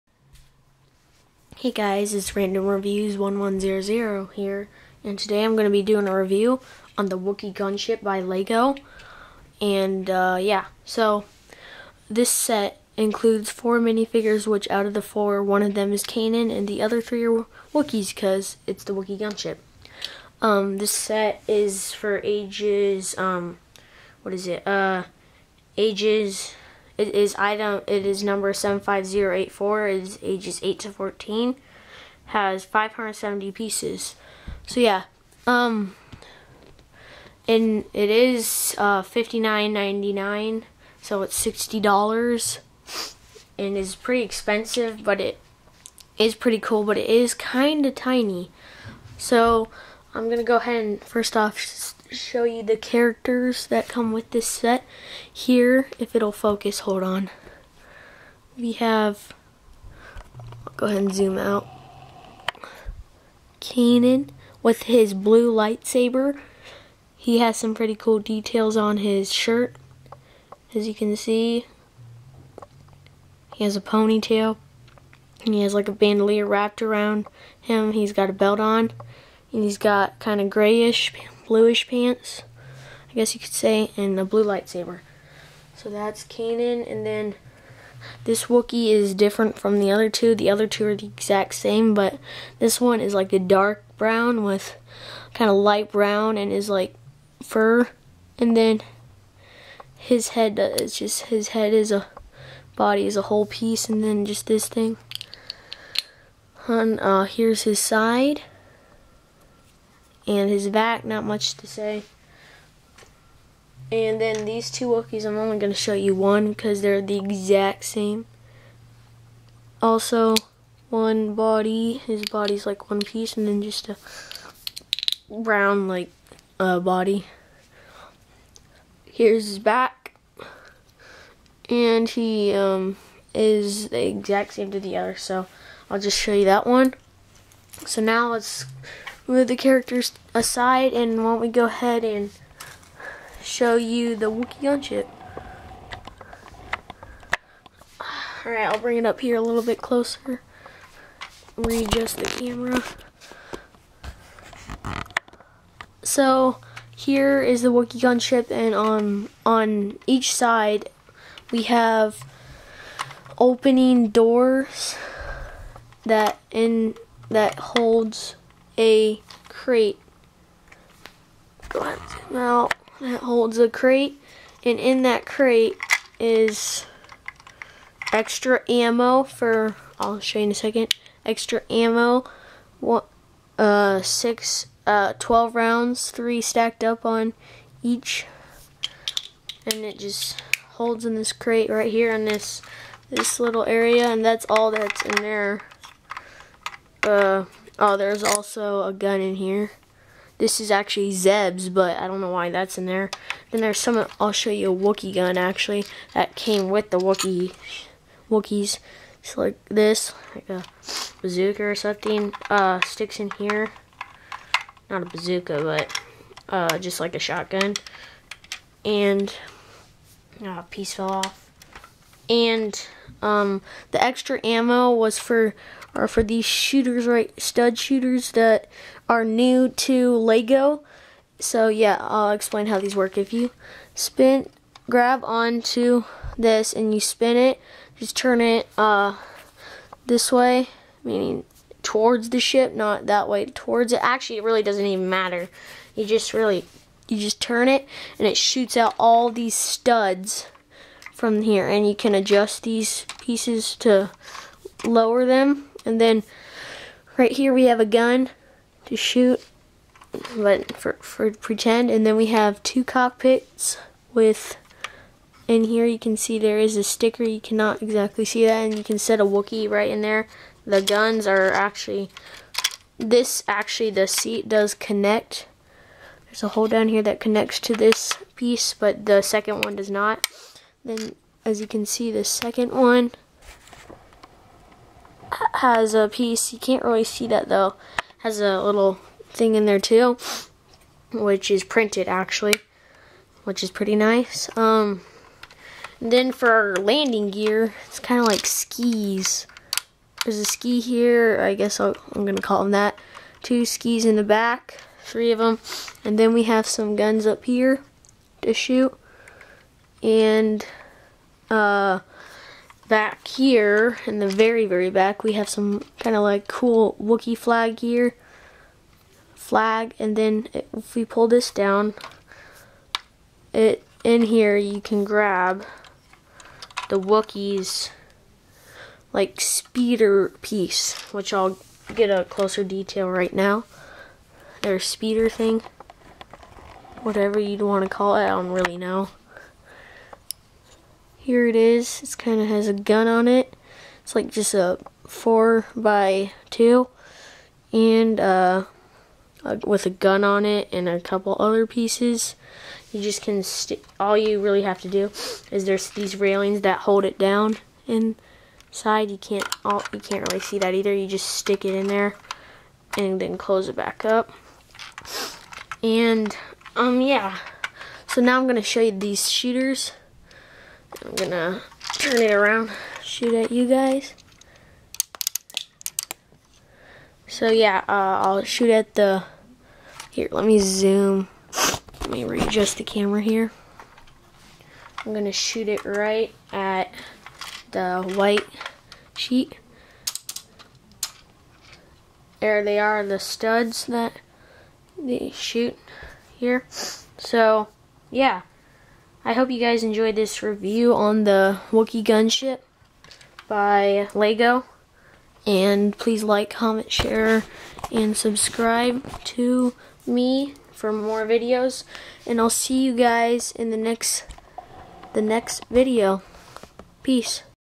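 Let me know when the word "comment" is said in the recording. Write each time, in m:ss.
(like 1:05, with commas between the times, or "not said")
6:46.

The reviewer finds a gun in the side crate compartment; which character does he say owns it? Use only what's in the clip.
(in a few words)
Zeb.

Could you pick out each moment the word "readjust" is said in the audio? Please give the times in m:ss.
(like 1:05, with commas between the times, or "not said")
2:31, 6:22.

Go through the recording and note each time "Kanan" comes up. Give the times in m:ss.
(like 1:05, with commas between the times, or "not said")
0:16, 1:03, 1:26.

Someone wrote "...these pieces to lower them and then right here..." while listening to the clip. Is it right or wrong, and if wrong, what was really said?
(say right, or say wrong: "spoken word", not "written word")
right.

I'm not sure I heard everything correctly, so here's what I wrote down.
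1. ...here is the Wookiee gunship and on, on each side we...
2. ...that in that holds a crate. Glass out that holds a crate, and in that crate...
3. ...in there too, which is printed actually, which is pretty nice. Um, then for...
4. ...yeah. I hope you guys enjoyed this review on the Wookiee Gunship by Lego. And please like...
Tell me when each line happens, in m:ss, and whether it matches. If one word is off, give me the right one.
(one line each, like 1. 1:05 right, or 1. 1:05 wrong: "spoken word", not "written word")
1. 2:36 right
2. 2:46 right
3. 4:49 right
4. 6:38 right.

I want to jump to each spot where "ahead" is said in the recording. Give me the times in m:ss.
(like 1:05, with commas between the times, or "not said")
0:50, 1:00, 2:21.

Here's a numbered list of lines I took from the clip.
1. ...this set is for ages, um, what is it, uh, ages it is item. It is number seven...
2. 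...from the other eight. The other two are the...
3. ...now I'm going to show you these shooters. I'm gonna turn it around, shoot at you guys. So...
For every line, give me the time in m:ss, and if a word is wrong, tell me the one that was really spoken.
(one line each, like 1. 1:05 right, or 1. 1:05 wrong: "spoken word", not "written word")
1. 0:20 right
2. 1:29 wrong: "two", not "eight"
3. 6:08 right.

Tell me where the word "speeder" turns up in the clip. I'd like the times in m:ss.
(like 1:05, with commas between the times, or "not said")
5:29, 5:34.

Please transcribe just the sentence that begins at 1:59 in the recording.
Also, one body, his body's like one piece, and then just a brown, like, uh, body.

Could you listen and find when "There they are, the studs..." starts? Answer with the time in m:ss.
6:32.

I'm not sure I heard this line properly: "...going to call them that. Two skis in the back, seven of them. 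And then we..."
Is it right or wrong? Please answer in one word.
wrong.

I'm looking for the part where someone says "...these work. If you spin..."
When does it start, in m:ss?
3:52.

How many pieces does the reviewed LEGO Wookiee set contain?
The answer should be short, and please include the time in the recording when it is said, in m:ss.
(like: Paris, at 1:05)
570, at 0:32.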